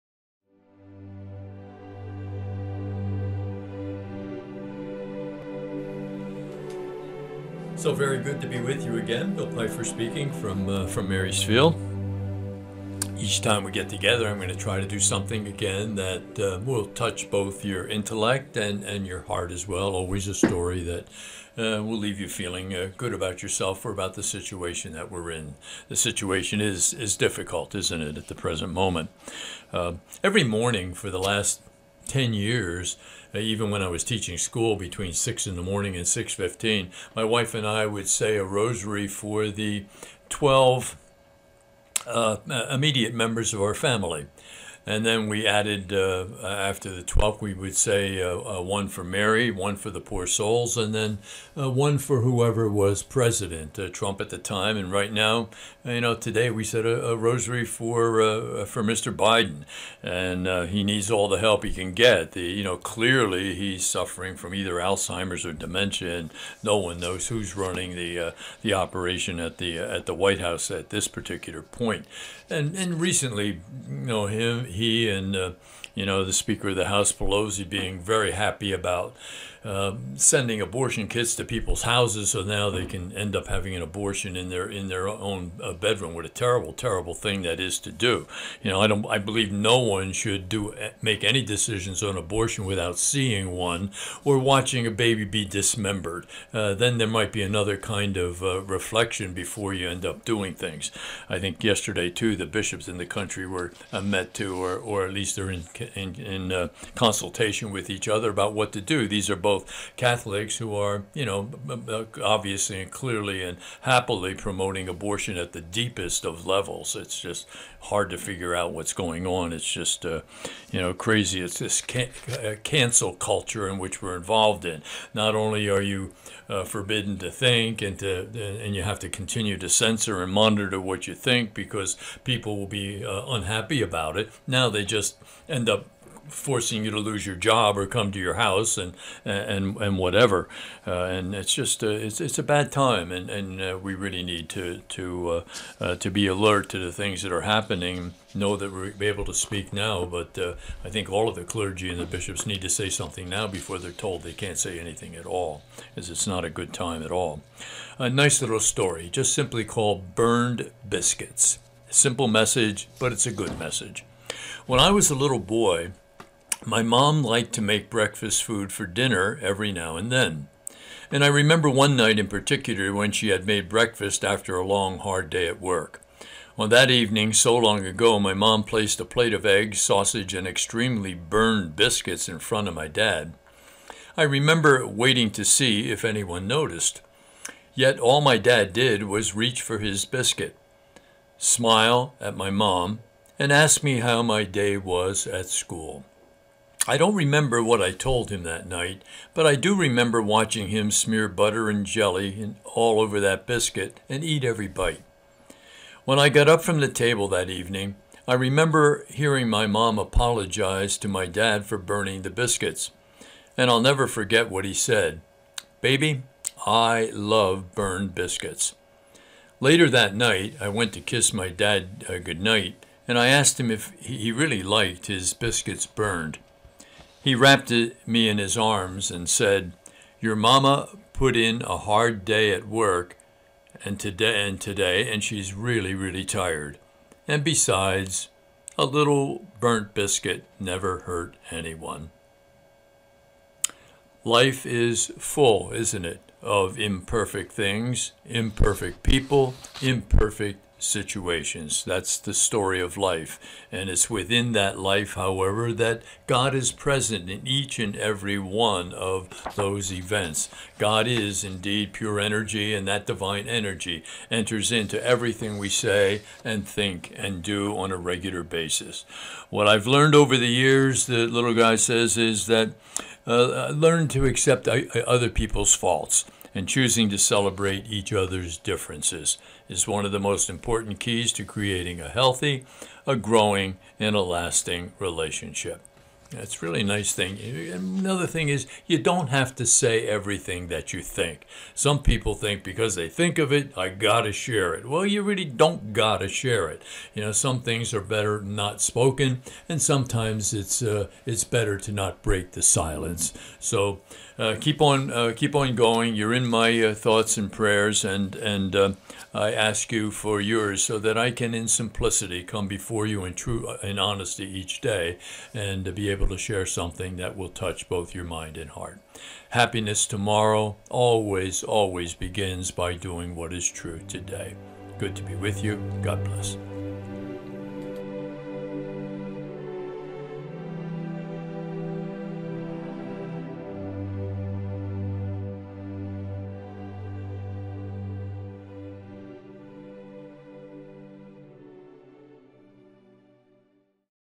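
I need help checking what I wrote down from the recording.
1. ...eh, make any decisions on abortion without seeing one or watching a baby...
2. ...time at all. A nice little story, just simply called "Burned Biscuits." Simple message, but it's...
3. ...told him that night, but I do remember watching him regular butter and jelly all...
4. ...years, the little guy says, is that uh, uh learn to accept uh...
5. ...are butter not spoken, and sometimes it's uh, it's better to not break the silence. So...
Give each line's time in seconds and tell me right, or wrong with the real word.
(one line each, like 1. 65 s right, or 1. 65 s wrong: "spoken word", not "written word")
1. 90 s right
2. 156 s right
3. 197 s wrong: "smear", not "regular"
4. 270 s right
5. 297 s wrong: "better", not "butter".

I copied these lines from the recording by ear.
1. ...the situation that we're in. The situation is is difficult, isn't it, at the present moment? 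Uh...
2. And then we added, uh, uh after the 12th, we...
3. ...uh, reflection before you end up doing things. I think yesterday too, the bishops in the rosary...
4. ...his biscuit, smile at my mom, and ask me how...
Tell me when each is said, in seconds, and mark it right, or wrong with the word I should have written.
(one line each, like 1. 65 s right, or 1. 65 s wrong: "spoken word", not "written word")
1. 24 s right
2. 44 s right
3. 98 s wrong: "country", not "rosary"
4. 189 s right.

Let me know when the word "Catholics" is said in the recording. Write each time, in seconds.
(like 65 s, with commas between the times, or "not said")
109 s.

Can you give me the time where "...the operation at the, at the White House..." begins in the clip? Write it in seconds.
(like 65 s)
68 s.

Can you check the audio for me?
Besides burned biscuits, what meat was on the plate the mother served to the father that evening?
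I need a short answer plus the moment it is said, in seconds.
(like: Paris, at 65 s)
Sausage, at 179 s.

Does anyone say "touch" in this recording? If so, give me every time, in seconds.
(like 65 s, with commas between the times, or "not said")
16 s, 317 s.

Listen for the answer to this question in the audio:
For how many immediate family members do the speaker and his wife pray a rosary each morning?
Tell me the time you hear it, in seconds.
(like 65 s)
40 s.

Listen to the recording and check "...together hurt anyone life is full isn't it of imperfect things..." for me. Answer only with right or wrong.
wrong.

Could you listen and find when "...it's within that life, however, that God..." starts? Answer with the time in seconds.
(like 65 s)
253 s.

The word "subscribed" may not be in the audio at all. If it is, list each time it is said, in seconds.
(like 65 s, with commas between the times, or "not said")
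not said.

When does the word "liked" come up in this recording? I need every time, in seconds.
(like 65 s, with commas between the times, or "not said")
167 s, 224 s.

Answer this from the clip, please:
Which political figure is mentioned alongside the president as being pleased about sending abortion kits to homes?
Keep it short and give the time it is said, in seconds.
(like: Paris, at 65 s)
Pelosi, at 77 s.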